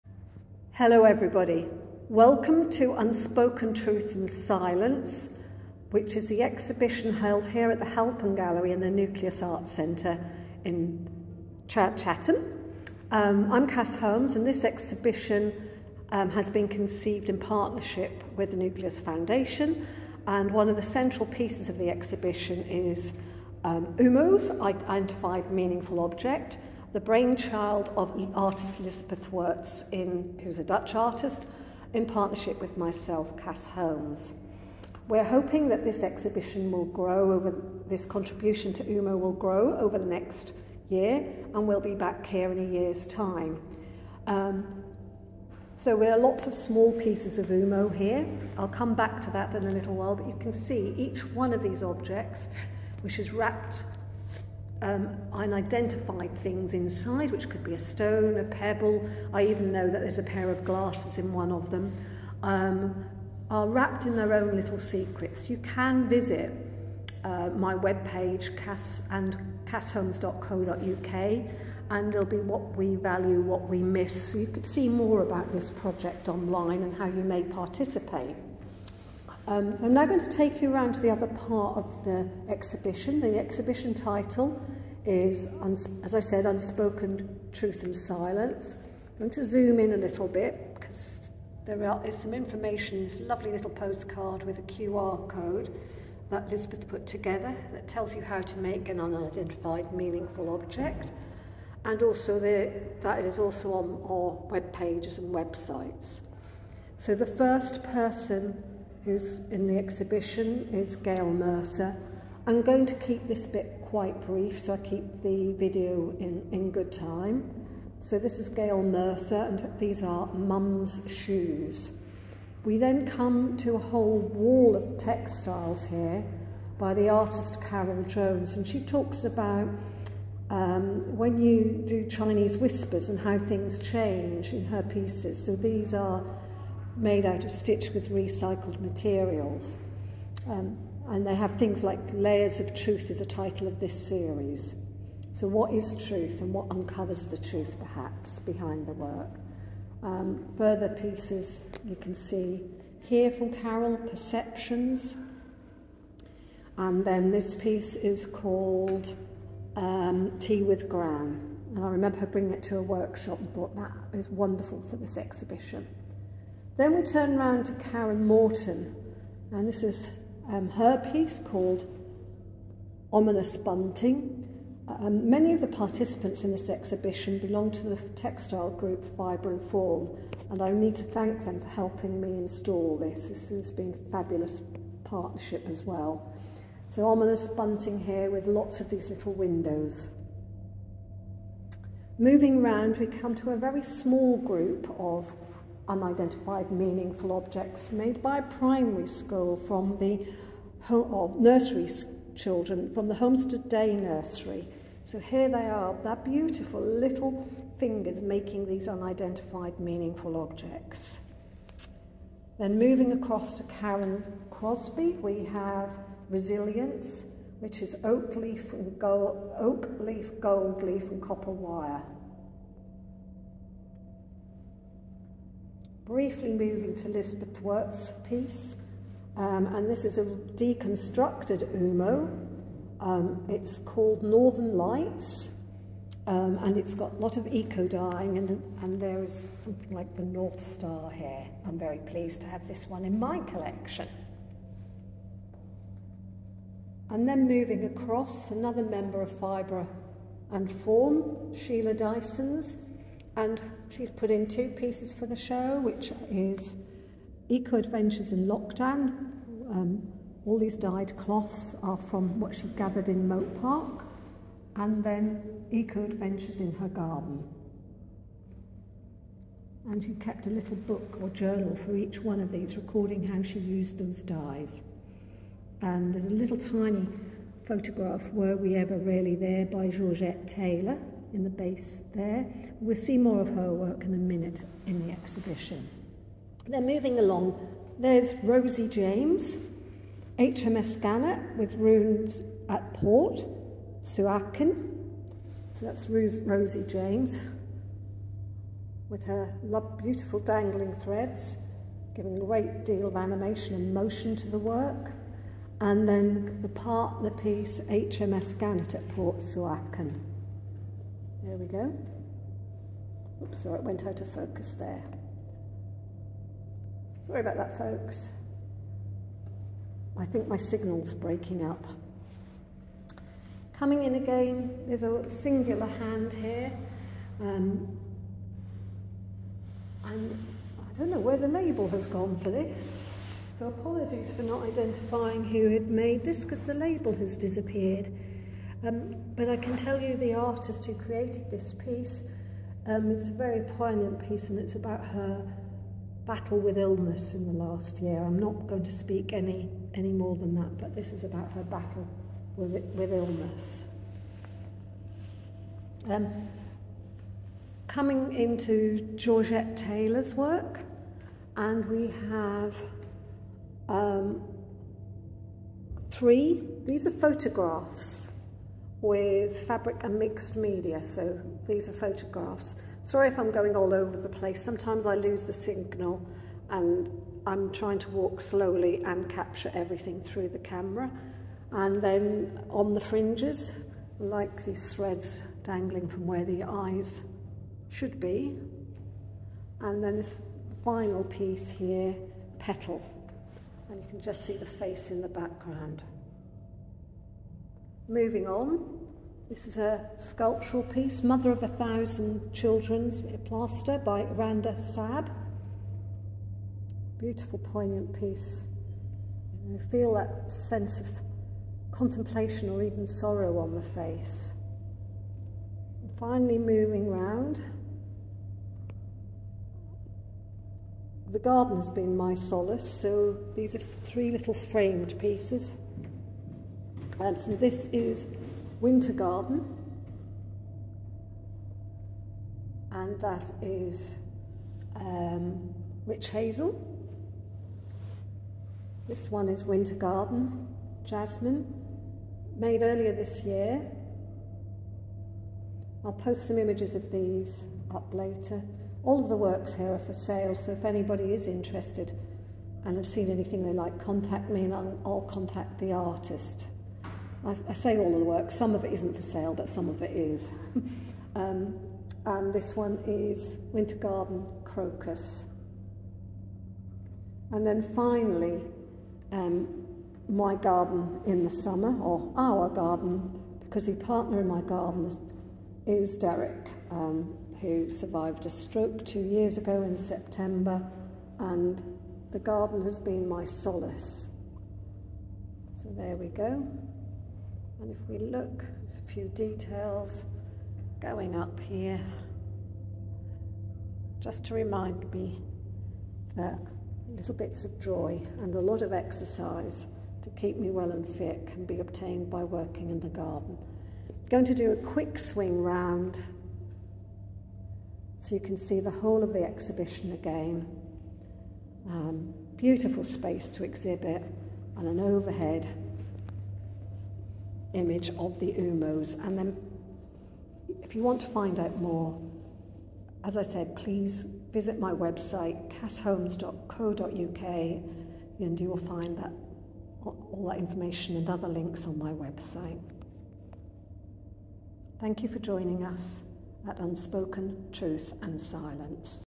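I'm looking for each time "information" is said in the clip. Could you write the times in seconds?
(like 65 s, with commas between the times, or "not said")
92 s, 530 s.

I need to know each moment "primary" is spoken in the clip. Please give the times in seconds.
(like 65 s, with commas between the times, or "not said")
198 s.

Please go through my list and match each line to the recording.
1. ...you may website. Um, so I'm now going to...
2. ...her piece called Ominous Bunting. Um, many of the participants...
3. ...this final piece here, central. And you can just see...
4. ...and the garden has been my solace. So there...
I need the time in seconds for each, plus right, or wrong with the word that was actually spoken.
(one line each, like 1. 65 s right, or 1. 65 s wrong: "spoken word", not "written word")
1. 77 s wrong: "participate", not "website"
2. 170 s right
3. 390 s wrong: "petal", not "central"
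4. 481 s right.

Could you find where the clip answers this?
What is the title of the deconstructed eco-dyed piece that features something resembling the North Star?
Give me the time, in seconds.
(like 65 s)
234 s.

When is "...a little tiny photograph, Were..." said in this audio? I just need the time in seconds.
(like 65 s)
276 s.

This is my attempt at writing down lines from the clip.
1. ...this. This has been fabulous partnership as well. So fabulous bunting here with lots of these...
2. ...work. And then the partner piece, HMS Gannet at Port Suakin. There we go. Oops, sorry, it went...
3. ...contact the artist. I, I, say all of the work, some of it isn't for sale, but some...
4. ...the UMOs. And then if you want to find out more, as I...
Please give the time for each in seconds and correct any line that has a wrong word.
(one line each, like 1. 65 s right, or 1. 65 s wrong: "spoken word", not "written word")
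1. 182 s wrong: "ominous", not "fabulous"
2. 304 s right
3. 455 s right
4. 518 s right.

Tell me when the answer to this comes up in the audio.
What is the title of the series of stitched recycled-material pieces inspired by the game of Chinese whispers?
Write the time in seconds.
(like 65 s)
142 s.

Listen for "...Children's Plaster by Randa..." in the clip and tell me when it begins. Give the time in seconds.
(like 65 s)
402 s.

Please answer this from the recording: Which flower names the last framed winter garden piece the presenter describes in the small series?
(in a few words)
Crocus.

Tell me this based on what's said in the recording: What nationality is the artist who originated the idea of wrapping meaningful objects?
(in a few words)
Dutch.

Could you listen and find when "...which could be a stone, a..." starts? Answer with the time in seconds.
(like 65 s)
57 s.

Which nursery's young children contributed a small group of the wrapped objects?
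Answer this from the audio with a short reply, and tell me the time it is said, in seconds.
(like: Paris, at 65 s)
Homestead Day Nursery, at 203 s.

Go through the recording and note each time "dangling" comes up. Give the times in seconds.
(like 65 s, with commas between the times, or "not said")
300 s, 385 s.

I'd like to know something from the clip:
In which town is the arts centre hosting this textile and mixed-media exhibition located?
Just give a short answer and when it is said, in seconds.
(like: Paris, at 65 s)
Chatham, at 11 s.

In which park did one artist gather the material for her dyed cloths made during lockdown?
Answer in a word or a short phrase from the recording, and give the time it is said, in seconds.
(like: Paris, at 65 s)
Mote Park, at 263 s.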